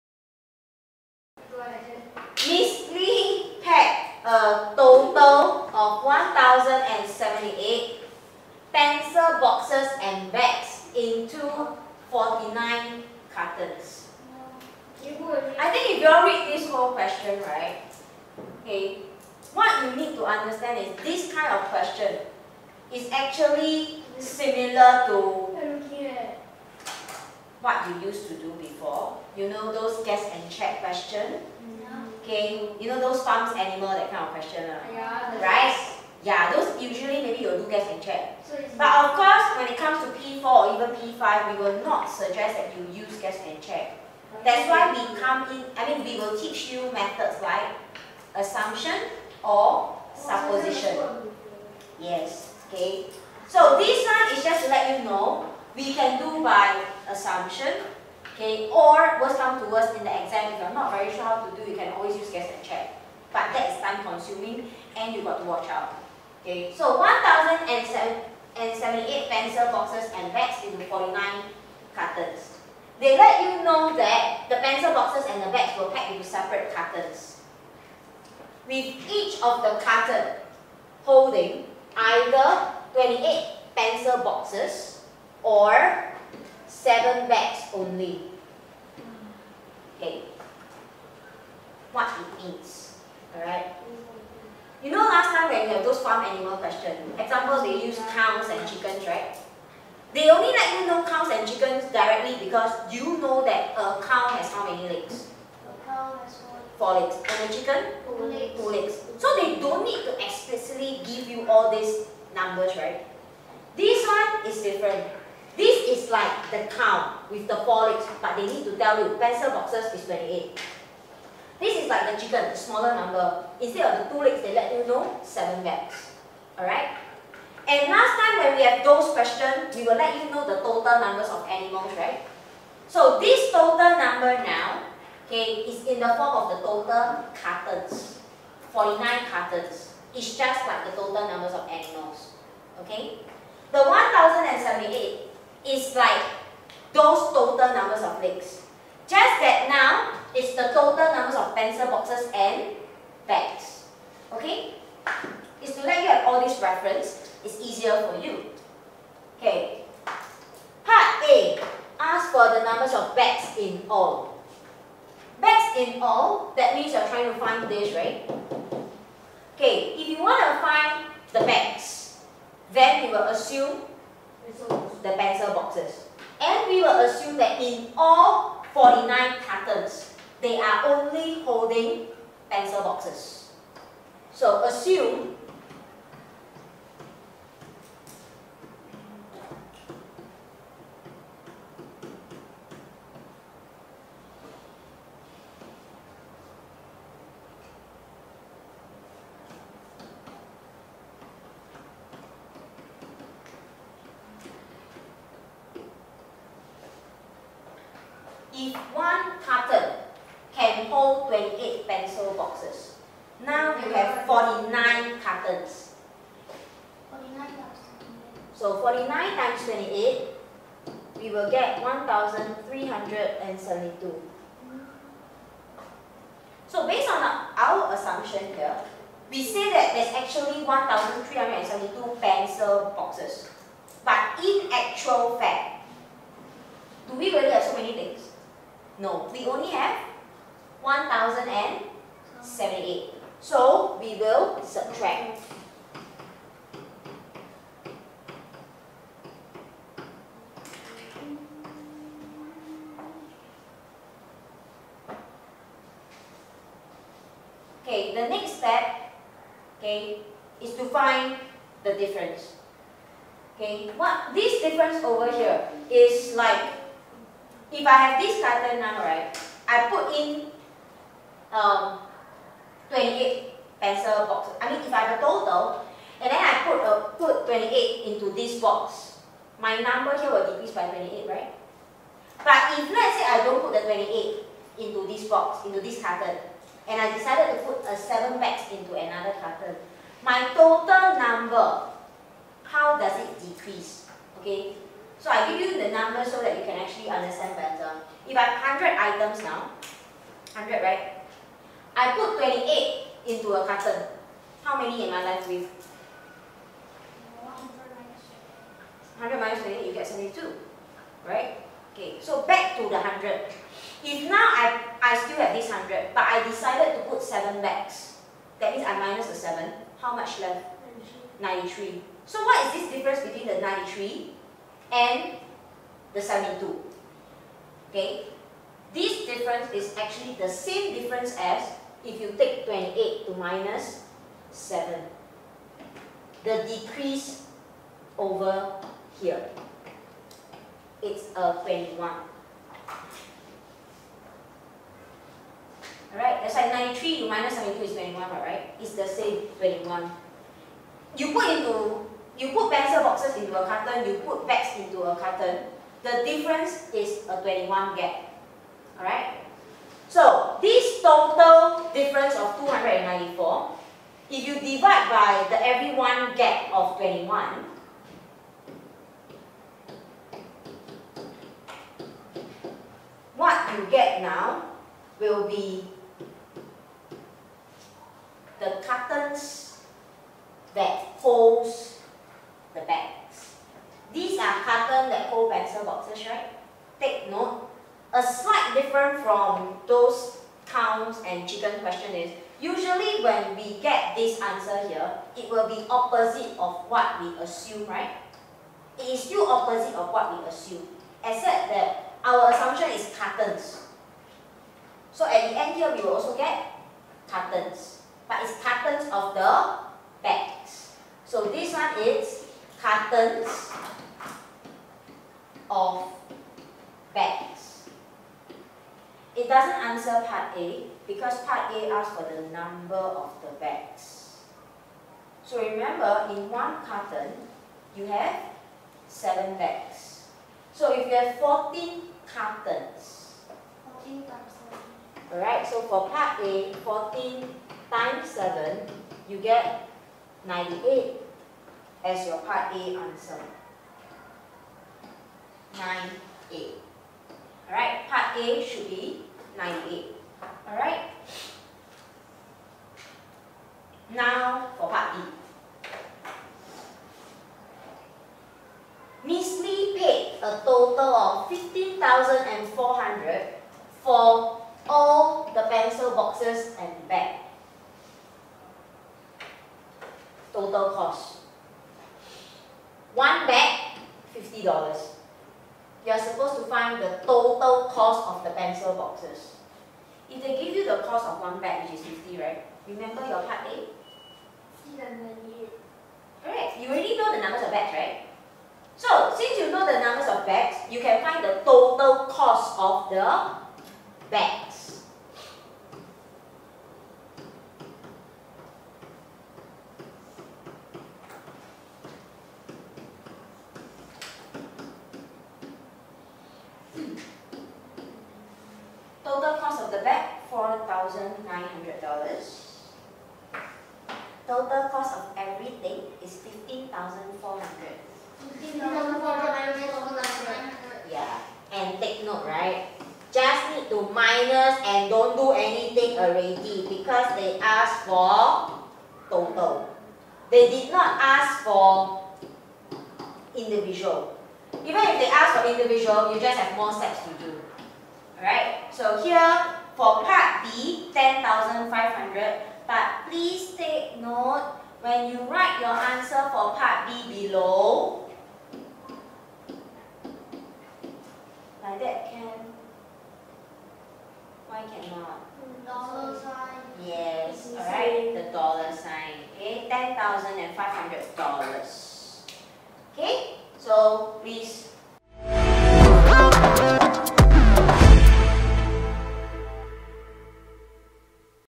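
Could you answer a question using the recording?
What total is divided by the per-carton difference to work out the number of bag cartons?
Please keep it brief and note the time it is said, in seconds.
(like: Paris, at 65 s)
294, at 362 s.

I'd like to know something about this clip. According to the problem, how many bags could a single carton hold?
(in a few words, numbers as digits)
7.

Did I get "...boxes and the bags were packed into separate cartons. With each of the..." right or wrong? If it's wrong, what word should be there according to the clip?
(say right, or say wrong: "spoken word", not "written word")
right.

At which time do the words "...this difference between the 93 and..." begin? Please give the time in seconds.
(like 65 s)
322 s.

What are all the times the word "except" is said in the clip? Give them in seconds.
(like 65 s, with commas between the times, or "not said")
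401 s.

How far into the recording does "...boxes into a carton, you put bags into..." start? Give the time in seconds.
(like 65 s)
353 s.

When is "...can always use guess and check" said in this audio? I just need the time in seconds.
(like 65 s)
61 s.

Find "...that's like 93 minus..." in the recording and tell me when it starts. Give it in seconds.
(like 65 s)
346 s.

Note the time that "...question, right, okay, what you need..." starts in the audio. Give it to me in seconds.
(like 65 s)
16 s.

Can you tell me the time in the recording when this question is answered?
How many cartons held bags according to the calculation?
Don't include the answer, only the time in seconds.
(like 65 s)
431 s.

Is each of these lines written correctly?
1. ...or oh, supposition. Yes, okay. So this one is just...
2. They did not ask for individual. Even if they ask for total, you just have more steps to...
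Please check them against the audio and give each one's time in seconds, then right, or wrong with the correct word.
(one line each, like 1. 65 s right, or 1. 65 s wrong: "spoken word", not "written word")
1. 49 s right
2. 530 s wrong: "individual", not "total".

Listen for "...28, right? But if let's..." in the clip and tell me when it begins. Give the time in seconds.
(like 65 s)
280 s.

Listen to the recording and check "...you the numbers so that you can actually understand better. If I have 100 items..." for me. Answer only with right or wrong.
right.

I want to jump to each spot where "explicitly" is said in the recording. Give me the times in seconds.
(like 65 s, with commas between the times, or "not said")
110 s.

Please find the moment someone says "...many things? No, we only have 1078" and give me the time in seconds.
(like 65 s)
237 s.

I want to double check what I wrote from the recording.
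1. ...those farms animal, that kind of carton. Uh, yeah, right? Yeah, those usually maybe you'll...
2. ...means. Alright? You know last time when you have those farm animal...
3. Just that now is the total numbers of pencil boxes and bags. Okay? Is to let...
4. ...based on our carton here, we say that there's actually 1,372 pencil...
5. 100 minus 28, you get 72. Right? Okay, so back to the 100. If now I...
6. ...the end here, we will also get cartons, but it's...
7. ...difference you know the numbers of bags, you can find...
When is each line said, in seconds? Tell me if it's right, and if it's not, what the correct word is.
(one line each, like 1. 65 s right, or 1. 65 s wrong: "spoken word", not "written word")
1. 32 s wrong: "question", not "carton"
2. 92 s right
3. 149 s right
4. 226 s wrong: "assumption", not "carton"
5. 309 s right
6. 405 s right
7. 489 s wrong: "since", not "difference".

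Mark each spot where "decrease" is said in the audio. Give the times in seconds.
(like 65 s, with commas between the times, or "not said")
280 s, 293 s, 336 s.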